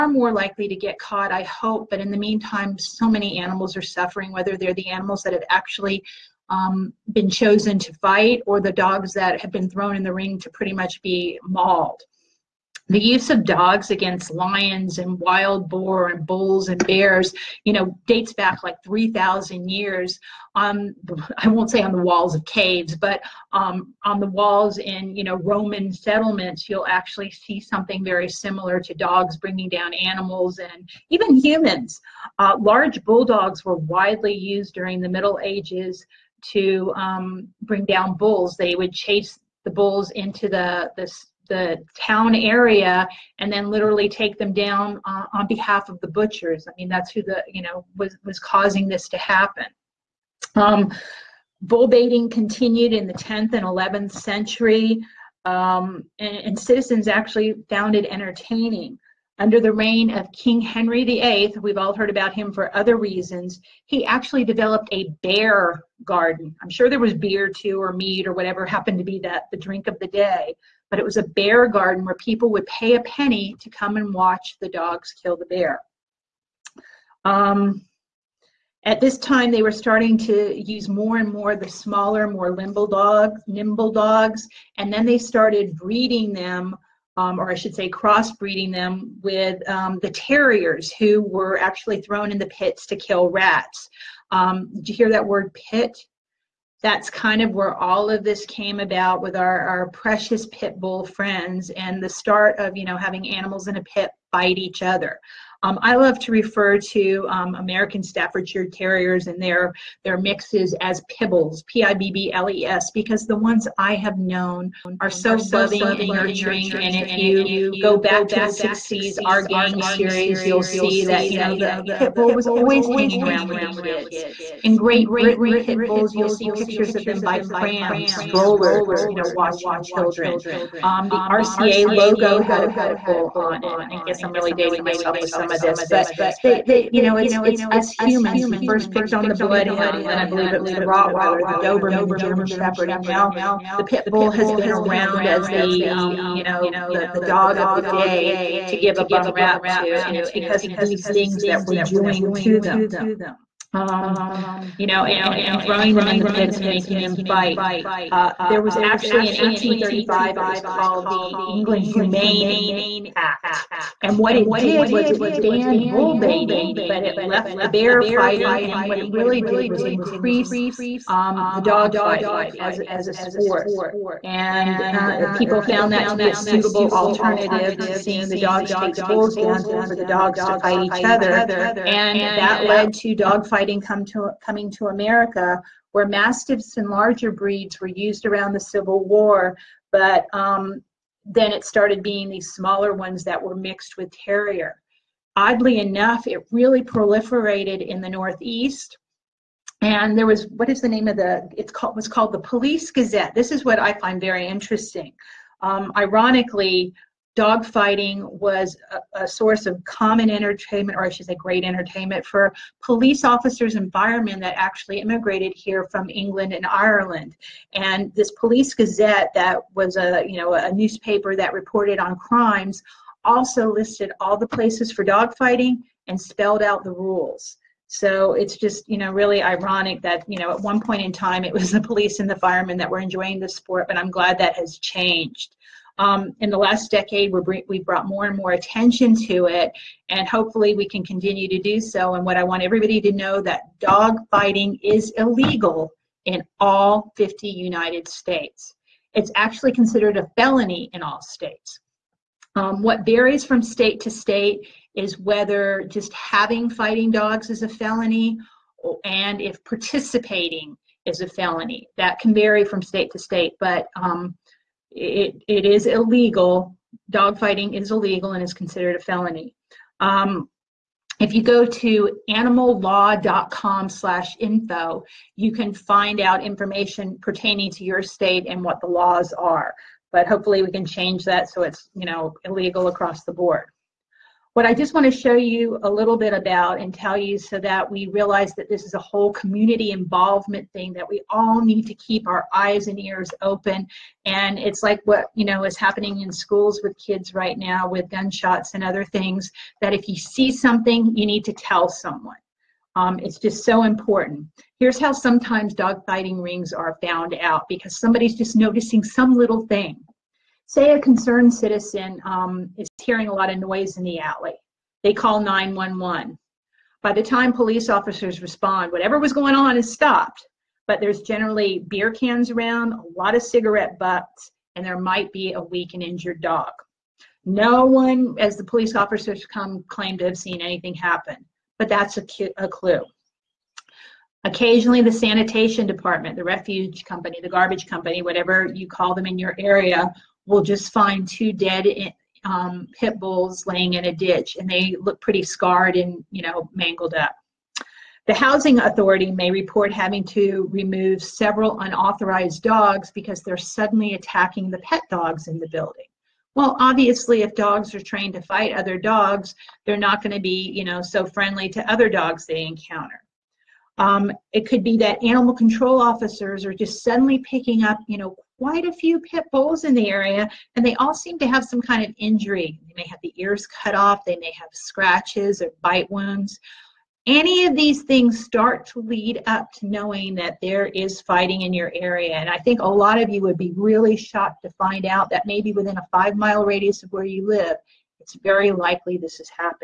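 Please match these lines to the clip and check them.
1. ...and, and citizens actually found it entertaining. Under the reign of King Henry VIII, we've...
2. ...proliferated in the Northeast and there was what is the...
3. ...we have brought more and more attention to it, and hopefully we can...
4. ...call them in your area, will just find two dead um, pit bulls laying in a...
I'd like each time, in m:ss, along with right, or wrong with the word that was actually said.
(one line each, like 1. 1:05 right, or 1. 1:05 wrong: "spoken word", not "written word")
1. 0:56 right
2. 3:16 right
3. 3:57 right
4. 5:38 right.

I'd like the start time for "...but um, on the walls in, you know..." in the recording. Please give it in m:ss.
0:22.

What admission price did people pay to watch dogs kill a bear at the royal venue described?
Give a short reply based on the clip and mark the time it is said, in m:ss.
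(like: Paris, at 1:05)
a penny, at 1:12.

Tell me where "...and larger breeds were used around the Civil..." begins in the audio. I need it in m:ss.
3:06.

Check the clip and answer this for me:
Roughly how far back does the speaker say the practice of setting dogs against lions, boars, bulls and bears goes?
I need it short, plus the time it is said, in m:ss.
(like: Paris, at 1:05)
3,000 years, at 0:18.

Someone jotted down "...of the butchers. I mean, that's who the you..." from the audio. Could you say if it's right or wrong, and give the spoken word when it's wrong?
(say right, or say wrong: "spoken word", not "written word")
right.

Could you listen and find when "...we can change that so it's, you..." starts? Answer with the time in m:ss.
4:40.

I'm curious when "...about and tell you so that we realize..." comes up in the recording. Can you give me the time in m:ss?
4:46.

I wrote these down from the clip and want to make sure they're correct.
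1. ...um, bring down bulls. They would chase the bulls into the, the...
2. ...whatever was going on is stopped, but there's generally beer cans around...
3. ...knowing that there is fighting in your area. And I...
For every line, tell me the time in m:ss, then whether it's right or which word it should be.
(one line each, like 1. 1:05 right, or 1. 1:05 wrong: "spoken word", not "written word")
1. 0:36 right
2. 5:18 right
3. 6:19 right.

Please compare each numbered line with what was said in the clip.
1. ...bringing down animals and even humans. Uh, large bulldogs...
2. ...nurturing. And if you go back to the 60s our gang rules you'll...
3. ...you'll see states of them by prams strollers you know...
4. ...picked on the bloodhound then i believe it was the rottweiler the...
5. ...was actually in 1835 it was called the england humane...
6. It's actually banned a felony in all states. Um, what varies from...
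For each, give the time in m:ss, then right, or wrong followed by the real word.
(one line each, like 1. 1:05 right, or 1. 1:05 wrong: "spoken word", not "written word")
1. 0:29 right
2. 1:56 wrong: "series", not "rules"
3. 2:06 wrong: "pictures", not "states"
4. 2:18 right
5. 2:38 right
6. 4:09 wrong: "considered", not "banned".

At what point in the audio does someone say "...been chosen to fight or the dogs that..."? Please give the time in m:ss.
0:07.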